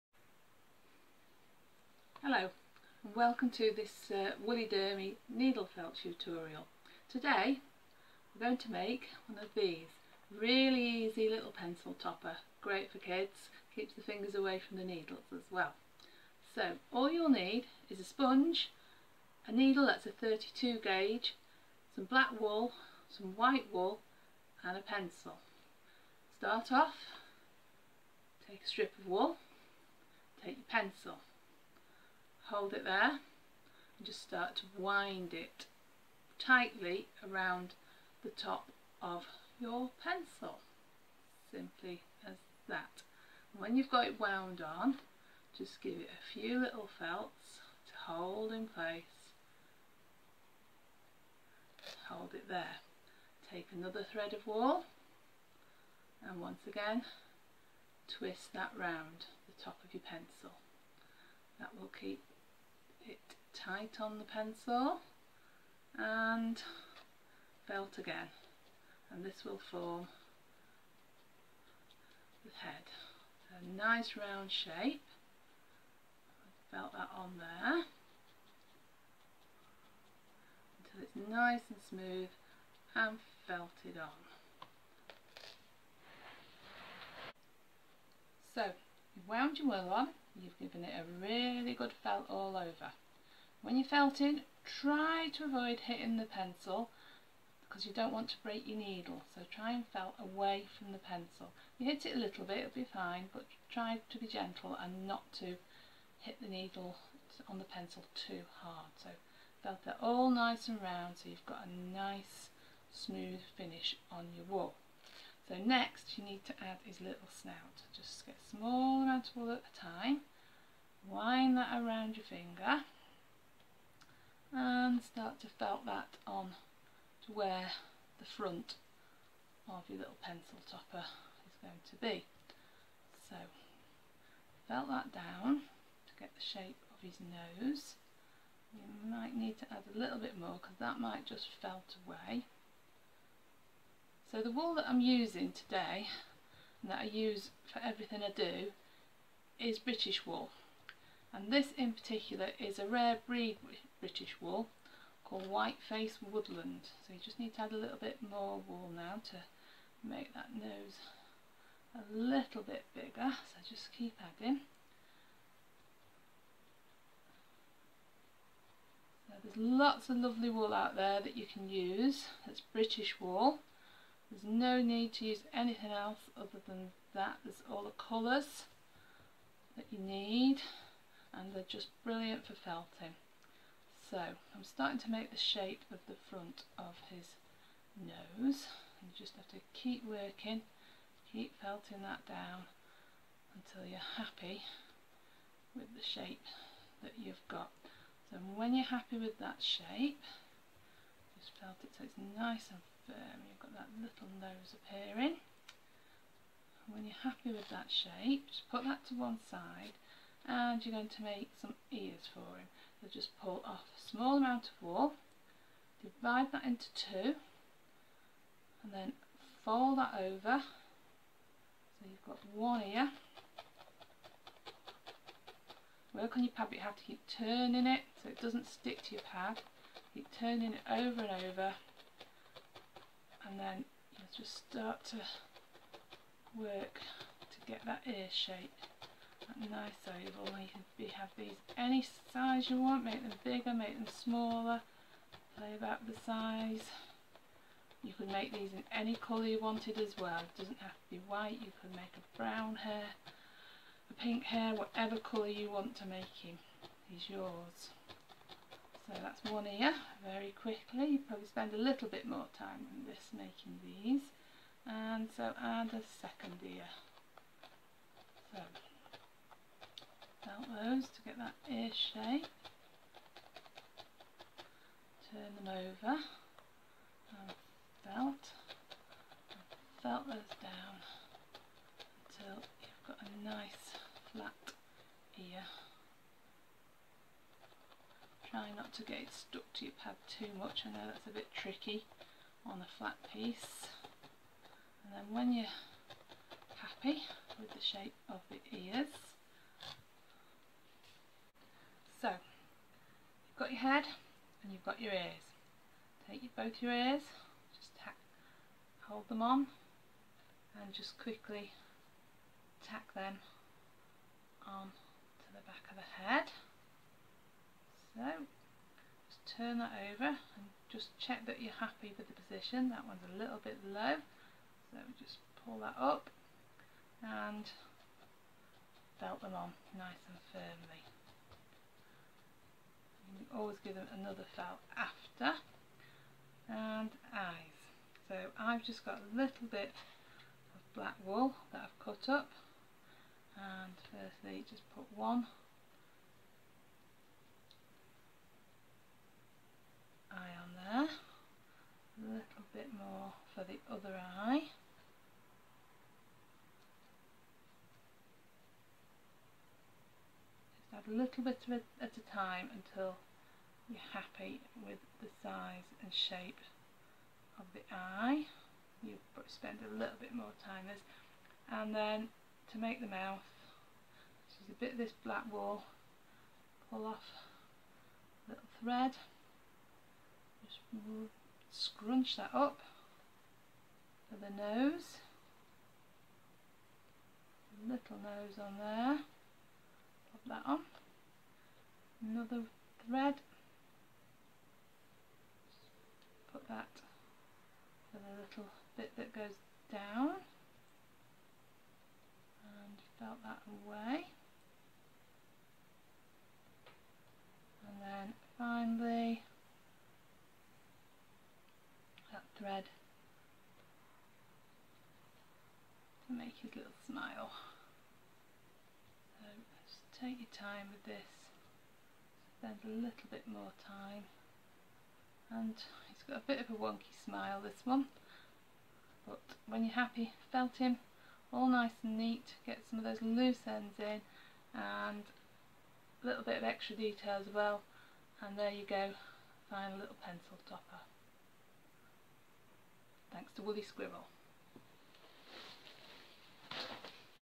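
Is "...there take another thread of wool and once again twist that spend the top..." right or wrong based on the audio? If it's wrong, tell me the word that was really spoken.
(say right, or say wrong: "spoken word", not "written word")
wrong: "round", not "spend".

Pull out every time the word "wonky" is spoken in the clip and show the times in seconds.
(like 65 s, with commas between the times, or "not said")
426 s.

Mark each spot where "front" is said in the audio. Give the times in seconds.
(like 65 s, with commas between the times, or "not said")
128 s, 186 s.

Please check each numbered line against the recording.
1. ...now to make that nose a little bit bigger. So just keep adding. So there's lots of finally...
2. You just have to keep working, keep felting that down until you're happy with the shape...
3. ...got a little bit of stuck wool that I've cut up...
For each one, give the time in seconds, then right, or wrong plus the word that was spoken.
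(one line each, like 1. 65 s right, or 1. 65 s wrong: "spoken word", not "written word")
1. 158 s wrong: "lovely", not "finally"
2. 189 s right
3. 339 s wrong: "black", not "stuck".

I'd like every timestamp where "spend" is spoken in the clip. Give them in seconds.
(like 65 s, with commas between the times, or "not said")
261 s, 369 s, 422 s.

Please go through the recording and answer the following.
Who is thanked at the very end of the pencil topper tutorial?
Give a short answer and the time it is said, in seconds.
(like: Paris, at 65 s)
Wuly Squirrel, at 443 s.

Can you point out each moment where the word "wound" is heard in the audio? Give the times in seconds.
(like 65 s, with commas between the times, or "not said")
44 s, 89 s.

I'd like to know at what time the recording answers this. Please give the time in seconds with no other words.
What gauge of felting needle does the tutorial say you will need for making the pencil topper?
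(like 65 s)
20 s.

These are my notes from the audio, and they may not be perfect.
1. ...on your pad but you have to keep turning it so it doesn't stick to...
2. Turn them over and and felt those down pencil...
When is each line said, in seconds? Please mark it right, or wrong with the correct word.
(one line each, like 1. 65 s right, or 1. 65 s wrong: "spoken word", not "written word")
1. 226 s right
2. 275 s wrong: "until", not "pencil".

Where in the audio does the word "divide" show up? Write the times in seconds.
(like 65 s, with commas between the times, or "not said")
216 s.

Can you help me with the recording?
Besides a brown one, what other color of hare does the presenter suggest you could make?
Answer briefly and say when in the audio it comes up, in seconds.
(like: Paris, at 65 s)
Pink, at 254 s.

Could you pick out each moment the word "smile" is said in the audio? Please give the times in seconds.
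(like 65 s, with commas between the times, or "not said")
417 s, 427 s.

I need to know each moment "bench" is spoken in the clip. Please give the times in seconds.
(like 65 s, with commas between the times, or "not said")
not said.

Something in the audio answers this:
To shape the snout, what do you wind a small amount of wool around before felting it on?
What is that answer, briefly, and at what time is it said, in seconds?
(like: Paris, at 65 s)
Your finger, at 121 s.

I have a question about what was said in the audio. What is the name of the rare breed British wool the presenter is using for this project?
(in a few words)
Whiteface Woodland.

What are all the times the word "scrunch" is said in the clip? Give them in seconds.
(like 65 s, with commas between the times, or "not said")
381 s.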